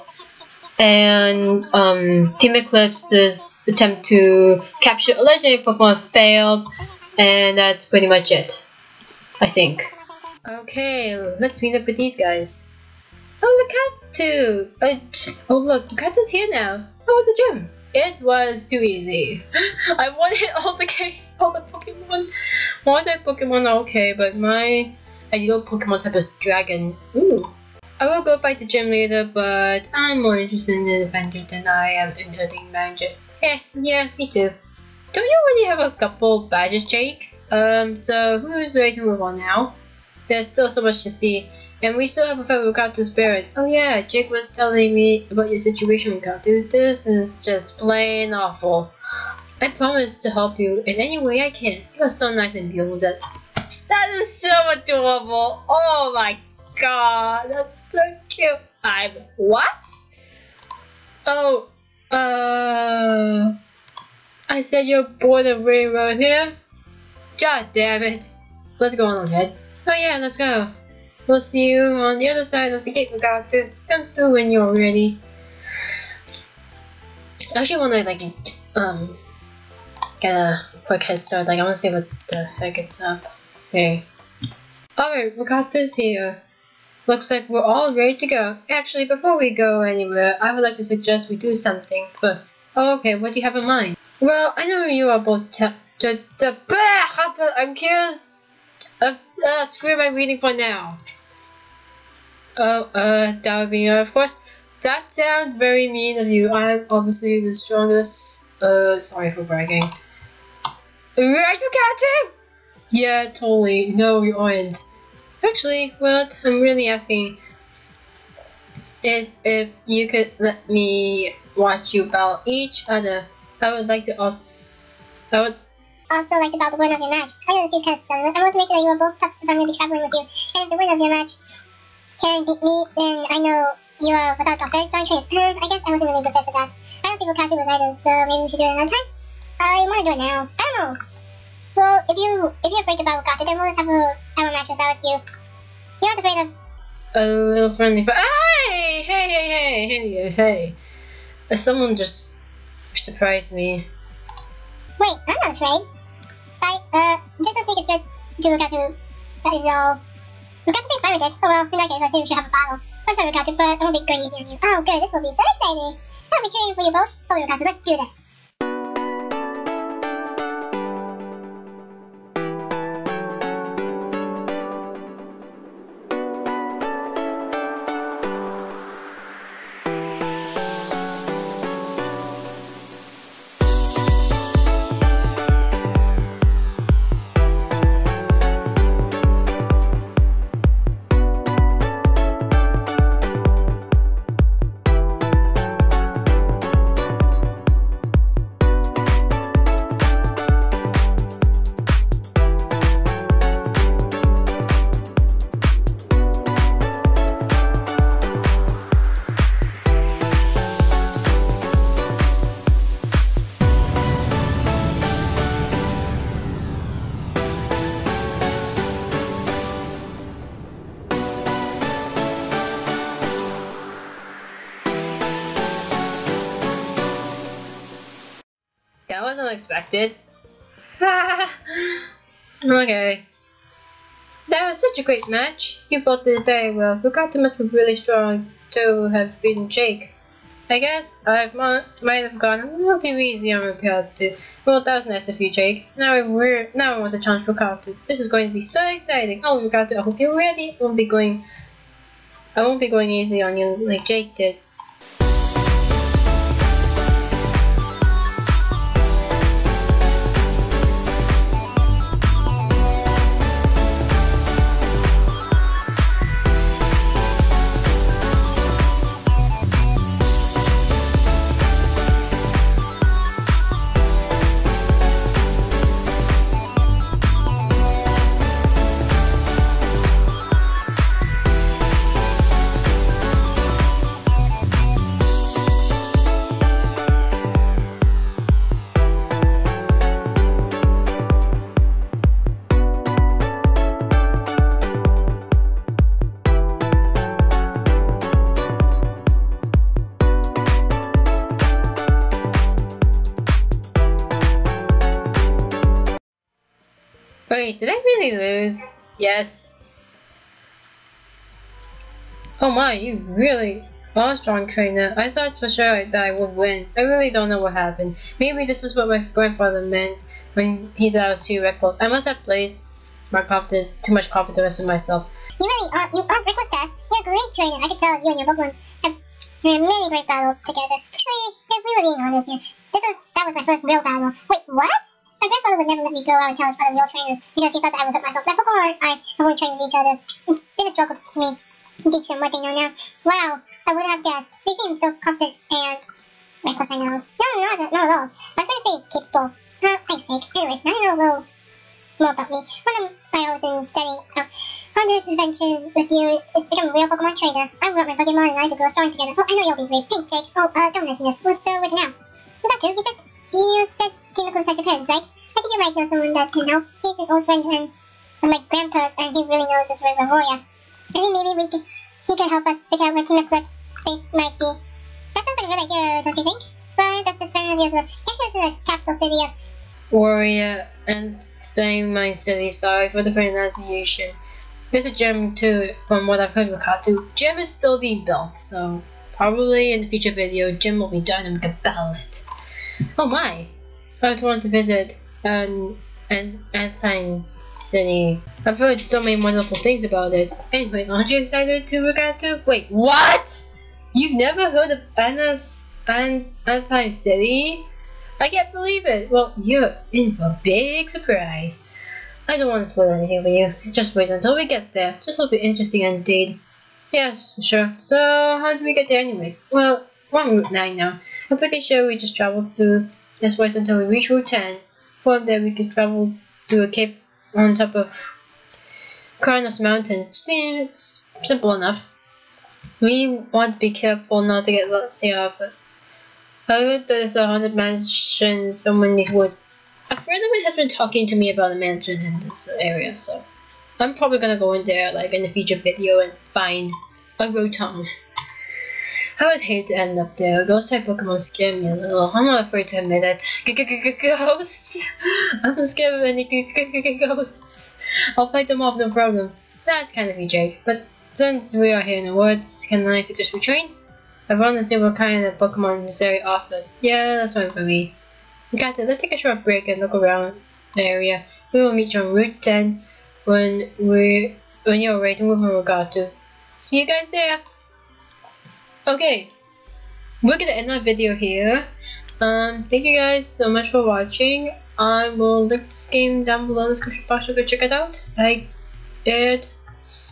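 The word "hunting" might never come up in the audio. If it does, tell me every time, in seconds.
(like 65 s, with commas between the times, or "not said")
32 s.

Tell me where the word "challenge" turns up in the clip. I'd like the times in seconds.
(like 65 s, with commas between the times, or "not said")
247 s, 336 s.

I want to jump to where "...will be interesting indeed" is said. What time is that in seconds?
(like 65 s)
415 s.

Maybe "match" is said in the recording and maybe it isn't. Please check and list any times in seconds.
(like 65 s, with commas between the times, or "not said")
127 s, 131 s, 144 s, 235 s.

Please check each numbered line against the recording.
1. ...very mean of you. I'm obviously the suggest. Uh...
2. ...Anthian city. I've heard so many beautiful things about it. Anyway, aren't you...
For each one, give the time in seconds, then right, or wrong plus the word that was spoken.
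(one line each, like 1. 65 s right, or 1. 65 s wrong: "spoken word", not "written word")
1. 105 s wrong: "strongest", not "suggest"
2. 396 s wrong: "wonderful", not "beautiful".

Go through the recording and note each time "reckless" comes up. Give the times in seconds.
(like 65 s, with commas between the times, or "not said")
321 s, 326 s, 346 s.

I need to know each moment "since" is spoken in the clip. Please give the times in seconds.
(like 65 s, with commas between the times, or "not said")
461 s.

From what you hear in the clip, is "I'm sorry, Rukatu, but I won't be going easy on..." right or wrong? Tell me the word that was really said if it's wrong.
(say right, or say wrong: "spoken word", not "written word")
right.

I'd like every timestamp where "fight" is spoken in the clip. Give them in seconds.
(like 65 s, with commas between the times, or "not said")
28 s, 458 s.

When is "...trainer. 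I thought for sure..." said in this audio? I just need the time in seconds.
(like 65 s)
314 s.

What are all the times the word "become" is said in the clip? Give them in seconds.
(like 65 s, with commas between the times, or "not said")
356 s.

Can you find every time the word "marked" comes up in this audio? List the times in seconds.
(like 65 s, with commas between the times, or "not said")
not said.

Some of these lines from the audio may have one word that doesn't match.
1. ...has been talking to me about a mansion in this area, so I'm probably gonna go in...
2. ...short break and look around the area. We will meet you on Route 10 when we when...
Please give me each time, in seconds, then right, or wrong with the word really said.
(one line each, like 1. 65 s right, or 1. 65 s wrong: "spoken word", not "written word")
1. 440 s right
2. 469 s right.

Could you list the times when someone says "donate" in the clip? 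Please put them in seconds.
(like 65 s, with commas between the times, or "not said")
not said.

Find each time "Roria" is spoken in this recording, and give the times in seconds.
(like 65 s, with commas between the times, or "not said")
370 s, 380 s.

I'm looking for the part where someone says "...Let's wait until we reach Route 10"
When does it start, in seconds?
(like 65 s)
423 s.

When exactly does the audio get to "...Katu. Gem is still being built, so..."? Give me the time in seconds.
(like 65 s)
386 s.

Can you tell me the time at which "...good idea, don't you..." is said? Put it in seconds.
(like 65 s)
375 s.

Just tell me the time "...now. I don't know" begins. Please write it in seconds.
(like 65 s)
140 s.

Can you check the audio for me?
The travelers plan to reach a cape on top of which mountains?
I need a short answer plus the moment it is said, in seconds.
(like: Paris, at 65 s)
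Cragonos Mountains, at 429 s.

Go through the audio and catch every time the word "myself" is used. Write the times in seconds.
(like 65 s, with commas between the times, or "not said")
324 s, 338 s.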